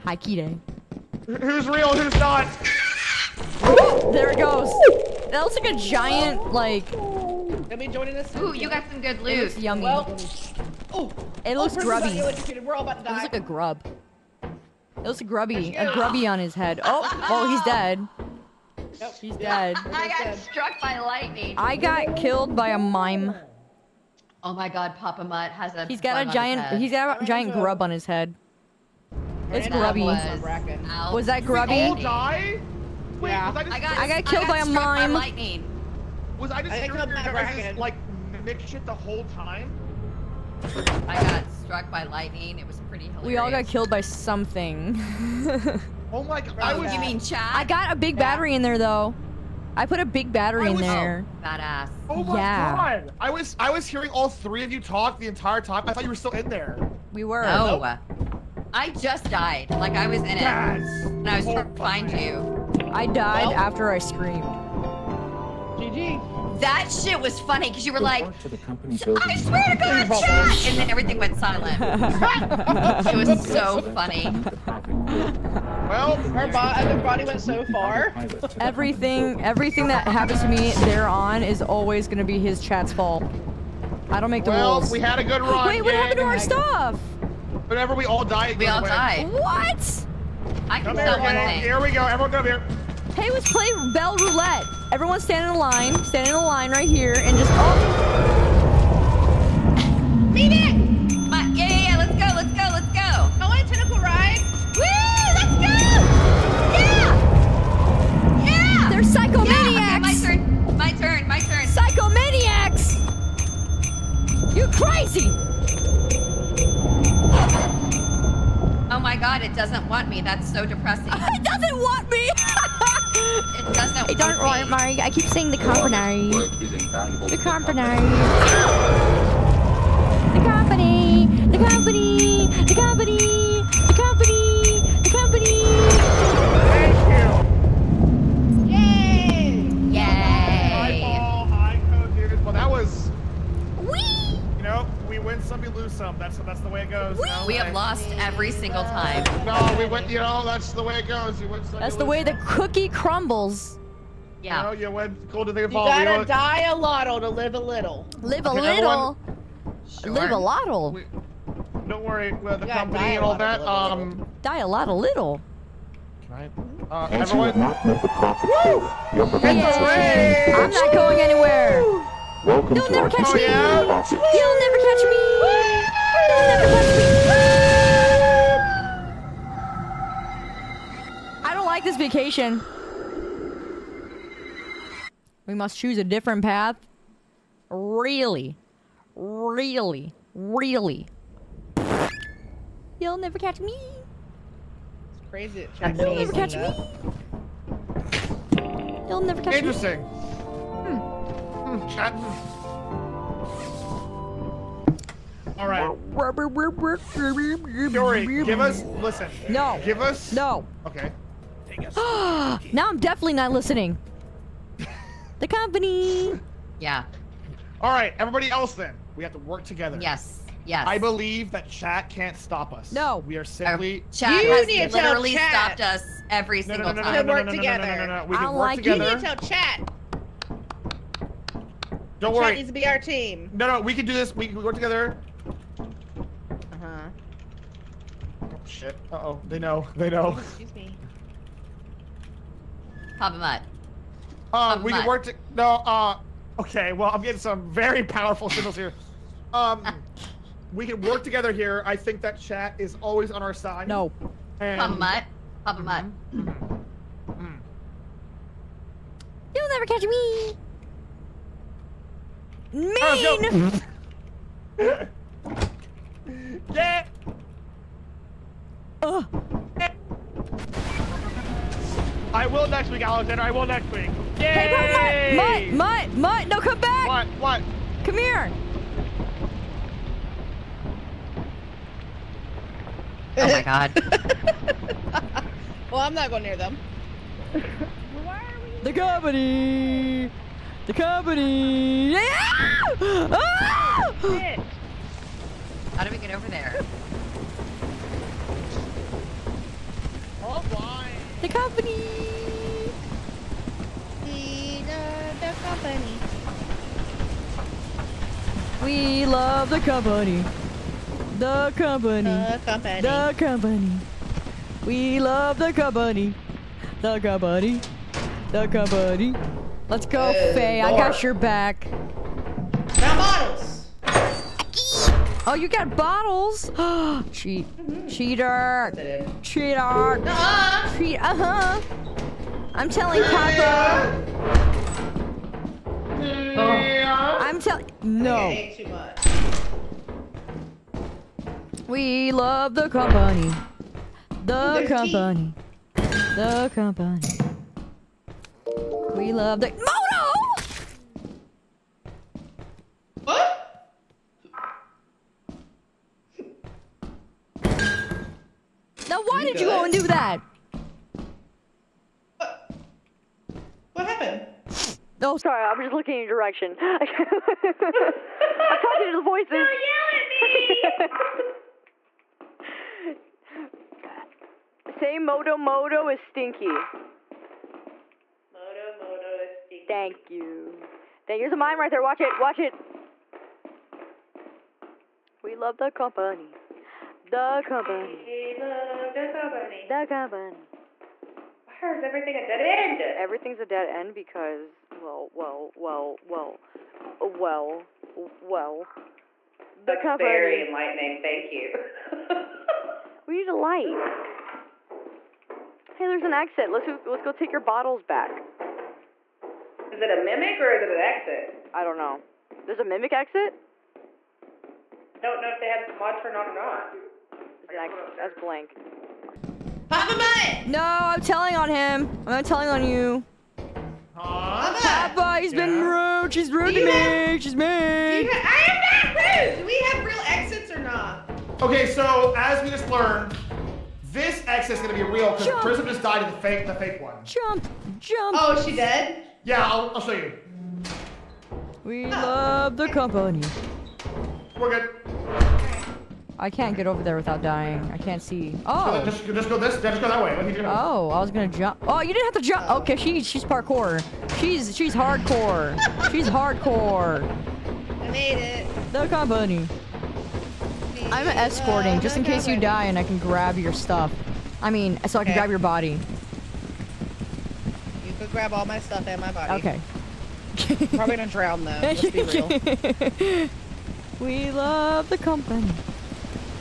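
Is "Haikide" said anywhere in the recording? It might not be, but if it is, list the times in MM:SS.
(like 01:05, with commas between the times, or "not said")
00:00.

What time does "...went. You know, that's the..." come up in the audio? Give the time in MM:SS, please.
02:29.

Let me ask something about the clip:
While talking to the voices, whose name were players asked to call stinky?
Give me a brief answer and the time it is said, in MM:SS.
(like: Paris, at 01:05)
Moto Moto, at 06:15.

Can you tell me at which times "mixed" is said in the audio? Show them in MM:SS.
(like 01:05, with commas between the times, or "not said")
00:38.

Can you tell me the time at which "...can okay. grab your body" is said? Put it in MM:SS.
07:45.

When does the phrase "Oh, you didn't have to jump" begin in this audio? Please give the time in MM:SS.
07:31.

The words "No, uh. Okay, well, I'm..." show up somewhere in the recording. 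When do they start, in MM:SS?
04:05.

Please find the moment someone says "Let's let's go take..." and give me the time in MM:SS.
06:46.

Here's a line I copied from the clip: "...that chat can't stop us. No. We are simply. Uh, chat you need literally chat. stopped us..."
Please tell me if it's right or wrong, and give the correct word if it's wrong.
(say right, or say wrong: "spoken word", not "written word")
right.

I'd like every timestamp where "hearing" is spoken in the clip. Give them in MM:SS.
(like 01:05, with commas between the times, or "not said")
00:53.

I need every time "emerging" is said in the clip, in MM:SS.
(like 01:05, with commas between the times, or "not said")
not said.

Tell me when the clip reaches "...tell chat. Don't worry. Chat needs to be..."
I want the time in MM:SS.
03:49.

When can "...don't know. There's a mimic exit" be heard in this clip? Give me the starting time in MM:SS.
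06:51.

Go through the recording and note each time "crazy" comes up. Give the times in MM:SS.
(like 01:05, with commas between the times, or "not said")
01:55, 03:15.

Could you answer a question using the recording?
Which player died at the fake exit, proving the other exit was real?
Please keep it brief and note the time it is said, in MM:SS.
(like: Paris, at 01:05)
Prism, at 07:15.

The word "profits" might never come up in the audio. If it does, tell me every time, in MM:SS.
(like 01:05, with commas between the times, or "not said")
02:53.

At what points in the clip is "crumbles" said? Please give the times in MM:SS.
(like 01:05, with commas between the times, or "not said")
02:32.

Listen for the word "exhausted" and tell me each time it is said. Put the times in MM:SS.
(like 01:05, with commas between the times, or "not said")
not said.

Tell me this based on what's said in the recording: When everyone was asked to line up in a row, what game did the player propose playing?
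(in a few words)
Bell Roulette.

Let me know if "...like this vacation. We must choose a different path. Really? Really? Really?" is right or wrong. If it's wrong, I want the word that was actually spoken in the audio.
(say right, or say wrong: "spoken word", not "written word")
right.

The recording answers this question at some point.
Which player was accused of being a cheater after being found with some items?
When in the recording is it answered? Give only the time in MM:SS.
05:20.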